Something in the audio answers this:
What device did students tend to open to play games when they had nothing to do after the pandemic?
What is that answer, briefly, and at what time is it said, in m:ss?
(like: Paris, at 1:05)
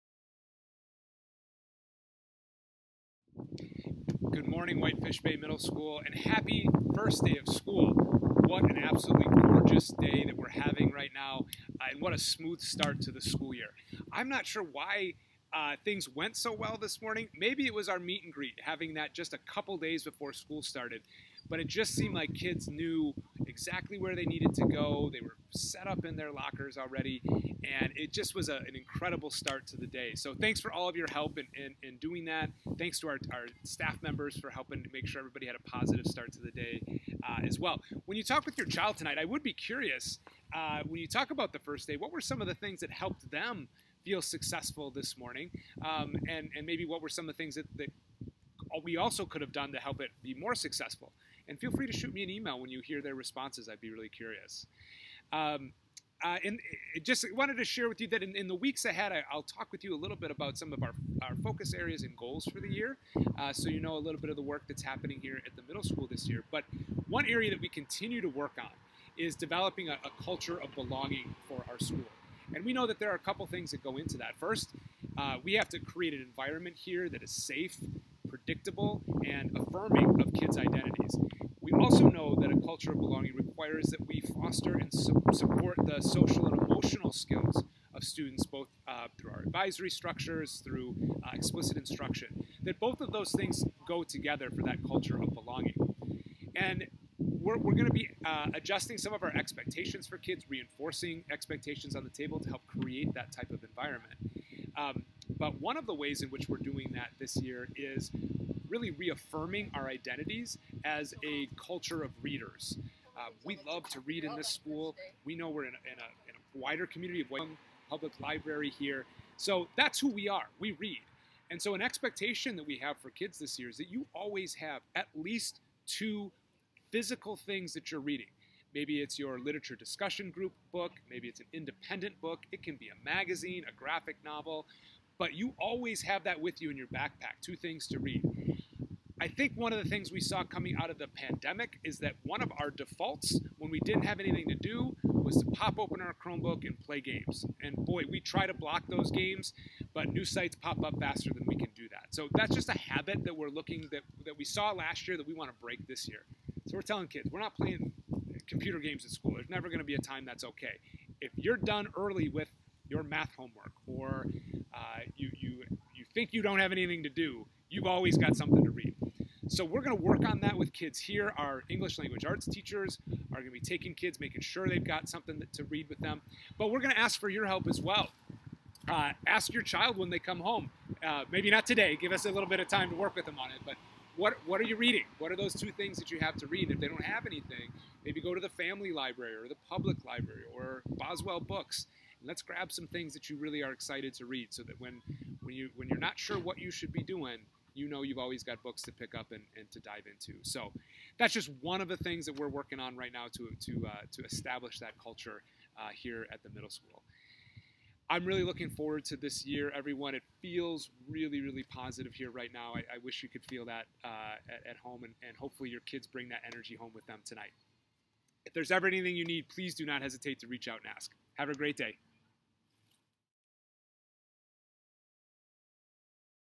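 Chromebook, at 2:26.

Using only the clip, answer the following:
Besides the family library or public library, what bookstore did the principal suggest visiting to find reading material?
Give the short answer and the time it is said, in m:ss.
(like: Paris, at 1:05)
Boswell Books, at 3:10.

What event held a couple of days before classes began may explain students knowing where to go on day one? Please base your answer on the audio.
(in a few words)
meet and greet.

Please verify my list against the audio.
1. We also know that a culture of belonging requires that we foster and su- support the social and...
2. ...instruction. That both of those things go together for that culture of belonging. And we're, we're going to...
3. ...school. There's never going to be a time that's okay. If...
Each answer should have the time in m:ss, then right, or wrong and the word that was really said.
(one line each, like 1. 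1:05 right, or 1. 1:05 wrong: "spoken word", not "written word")
1. 1:21 right
2. 1:31 right
3. 2:39 right.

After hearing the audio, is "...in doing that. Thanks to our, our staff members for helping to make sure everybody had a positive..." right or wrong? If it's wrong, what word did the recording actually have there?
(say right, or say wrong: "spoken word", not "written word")
right.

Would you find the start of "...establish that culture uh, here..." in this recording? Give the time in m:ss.
3:24.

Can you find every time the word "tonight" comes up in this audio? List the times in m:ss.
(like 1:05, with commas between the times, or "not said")
0:38, 3:37.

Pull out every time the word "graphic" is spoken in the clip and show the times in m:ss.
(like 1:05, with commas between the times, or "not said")
2:13.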